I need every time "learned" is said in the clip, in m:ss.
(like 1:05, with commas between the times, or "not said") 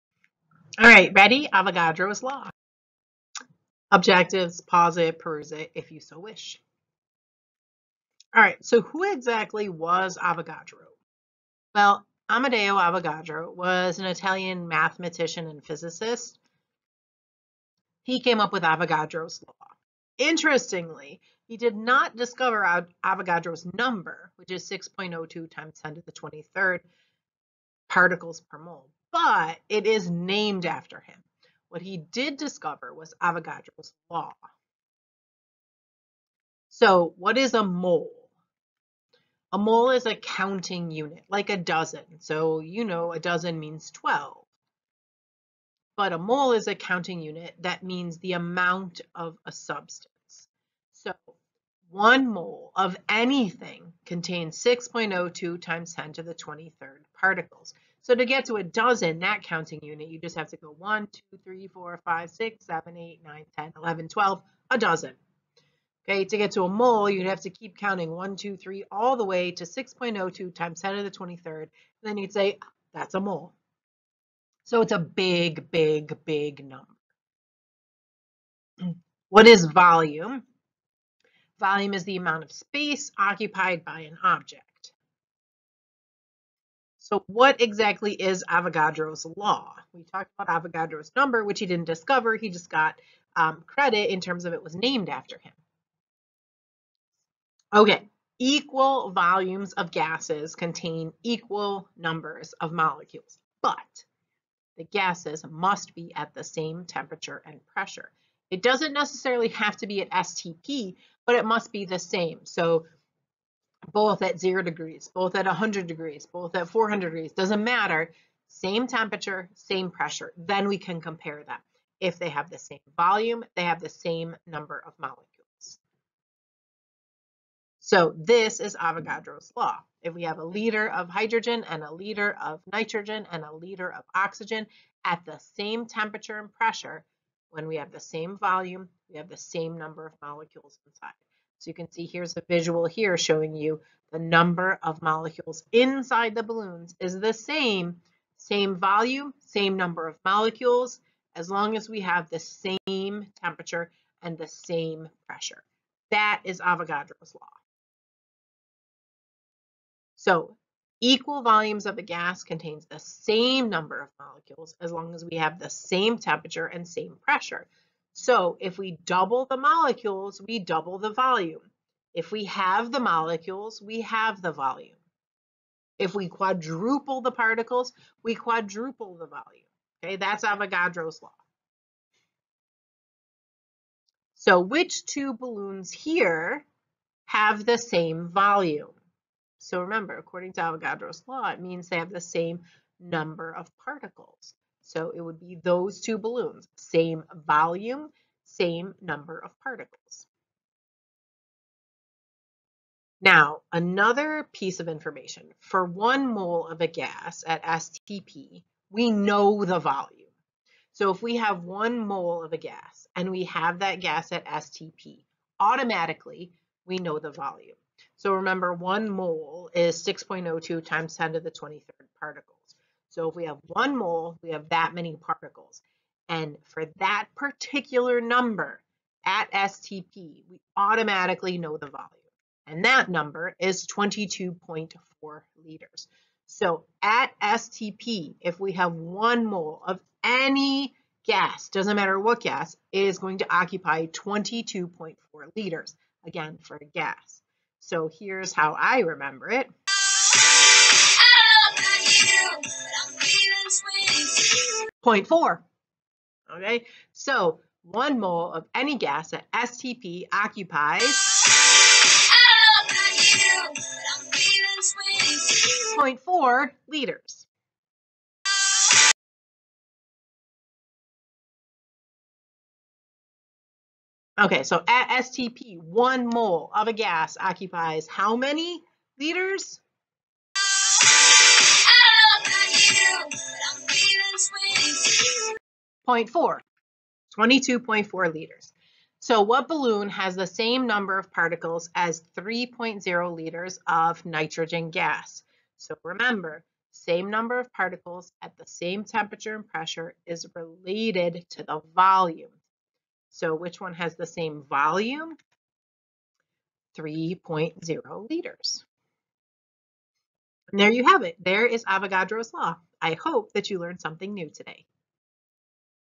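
5:13.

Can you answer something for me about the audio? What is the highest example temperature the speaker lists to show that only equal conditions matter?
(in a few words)
400 degrees.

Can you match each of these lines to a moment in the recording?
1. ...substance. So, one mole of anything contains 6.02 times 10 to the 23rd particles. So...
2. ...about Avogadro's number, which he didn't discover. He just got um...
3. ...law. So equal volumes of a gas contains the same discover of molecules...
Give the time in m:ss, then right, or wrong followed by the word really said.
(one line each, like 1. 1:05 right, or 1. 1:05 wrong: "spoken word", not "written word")
1. 0:49 right
2. 1:30 right
3. 2:37 wrong: "number", not "discover".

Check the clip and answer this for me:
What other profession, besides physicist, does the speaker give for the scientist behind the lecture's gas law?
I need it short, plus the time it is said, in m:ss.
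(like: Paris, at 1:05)
Mathematician, at 0:14.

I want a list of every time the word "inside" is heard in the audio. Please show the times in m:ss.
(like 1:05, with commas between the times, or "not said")
2:20, 2:25.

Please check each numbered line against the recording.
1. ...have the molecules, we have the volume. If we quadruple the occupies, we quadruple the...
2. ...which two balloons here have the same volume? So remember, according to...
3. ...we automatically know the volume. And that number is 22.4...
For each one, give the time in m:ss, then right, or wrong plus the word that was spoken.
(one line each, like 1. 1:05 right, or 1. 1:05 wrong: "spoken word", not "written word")
1. 2:52 wrong: "particles", not "occupies"
2. 3:04 right
3. 3:50 right.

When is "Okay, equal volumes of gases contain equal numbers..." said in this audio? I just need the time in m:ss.
1:37.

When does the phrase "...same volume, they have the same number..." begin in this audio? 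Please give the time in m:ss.
2:02.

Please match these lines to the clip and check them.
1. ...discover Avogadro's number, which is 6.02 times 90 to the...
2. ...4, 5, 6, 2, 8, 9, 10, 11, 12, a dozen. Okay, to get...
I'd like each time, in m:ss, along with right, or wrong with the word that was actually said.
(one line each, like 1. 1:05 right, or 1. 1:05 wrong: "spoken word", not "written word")
1. 0:22 wrong: "10", not "90"
2. 1:01 wrong: "7", not "2".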